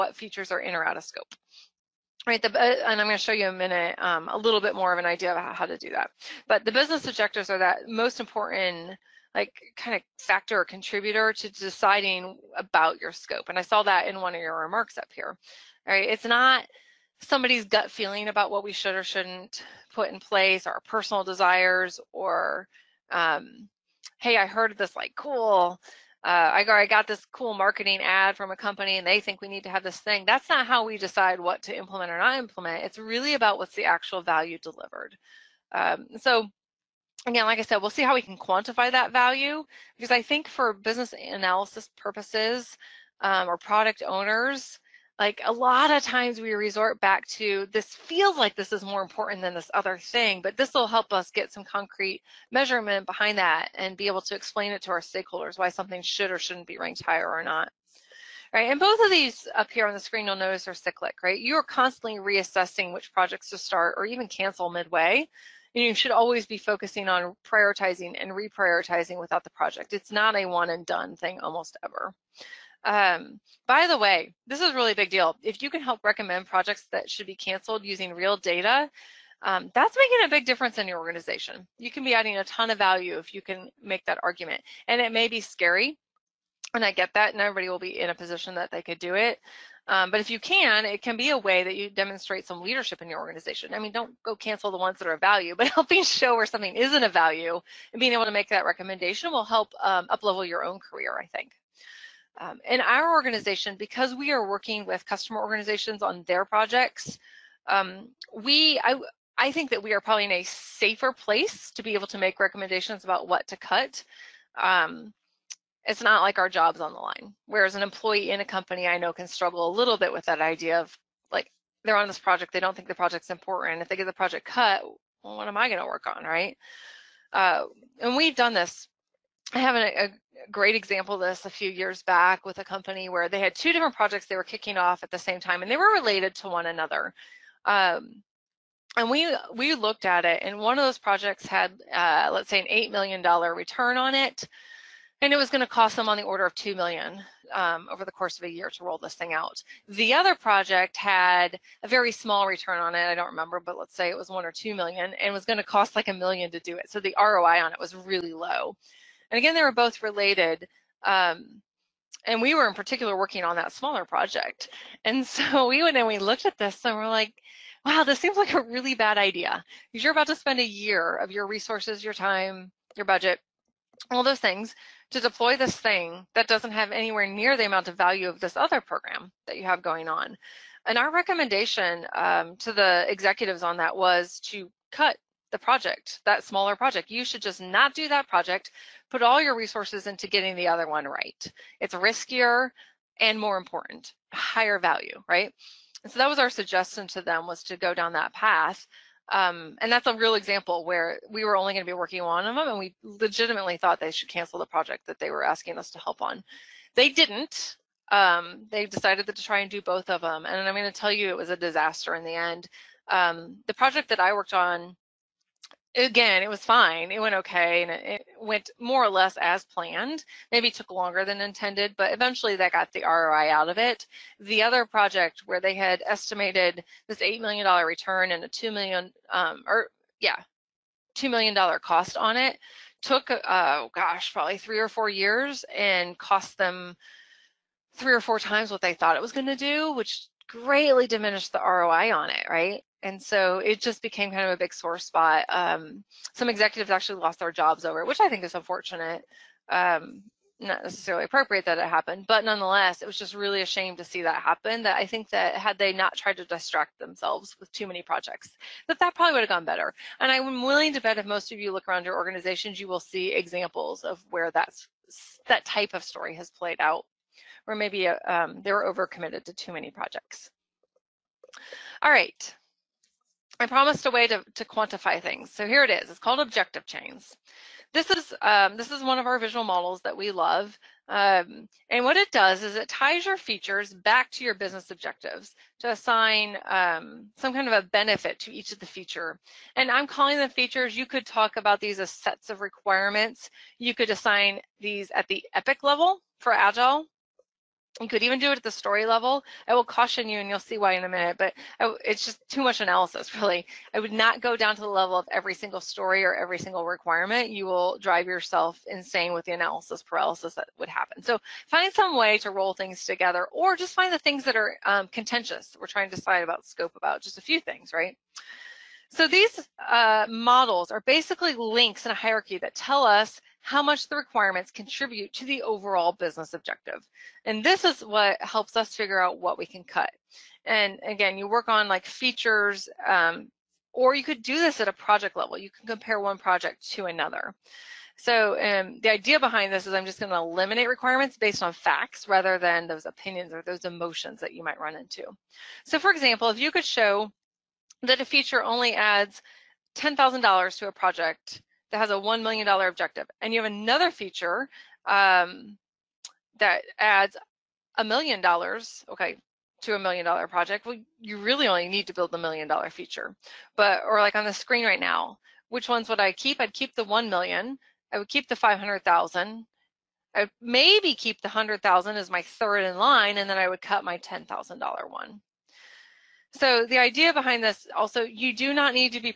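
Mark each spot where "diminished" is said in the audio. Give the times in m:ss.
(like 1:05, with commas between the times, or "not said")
4:01.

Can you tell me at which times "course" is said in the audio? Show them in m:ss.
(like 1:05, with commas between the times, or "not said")
2:28.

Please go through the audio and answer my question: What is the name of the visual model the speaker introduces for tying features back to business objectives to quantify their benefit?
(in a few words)
objective chains.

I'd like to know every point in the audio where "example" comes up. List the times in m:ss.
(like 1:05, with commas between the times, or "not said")
2:10, 3:20, 4:23, 5:46.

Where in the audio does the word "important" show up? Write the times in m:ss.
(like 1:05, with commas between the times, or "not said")
0:08, 0:49, 2:03, 3:13.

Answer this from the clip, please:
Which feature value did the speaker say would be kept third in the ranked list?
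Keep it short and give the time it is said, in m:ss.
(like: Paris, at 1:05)
$100,000, at 6:11.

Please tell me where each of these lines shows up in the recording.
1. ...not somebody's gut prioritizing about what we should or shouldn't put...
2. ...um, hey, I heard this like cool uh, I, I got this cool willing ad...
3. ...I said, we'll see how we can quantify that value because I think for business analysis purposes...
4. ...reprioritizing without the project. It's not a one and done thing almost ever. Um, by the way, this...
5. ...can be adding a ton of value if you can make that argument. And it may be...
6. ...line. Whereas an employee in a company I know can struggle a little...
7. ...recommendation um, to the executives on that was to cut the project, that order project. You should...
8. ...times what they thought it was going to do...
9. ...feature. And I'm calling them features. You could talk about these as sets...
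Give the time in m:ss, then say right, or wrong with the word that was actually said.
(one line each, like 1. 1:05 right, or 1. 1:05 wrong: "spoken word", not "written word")
1. 0:16 wrong: "feeling", not "prioritizing"
2. 0:23 wrong: "marketing", not "willing"
3. 0:37 right
4. 1:08 right
5. 1:21 right
6. 1:56 right
7. 3:01 wrong: "smaller", not "order"
8. 3:58 right
9. 4:48 right.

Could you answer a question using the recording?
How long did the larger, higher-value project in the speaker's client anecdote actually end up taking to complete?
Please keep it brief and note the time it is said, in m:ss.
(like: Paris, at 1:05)
3 or 4 years, at 3:54.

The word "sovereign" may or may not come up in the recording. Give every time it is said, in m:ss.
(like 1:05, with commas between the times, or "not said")
not said.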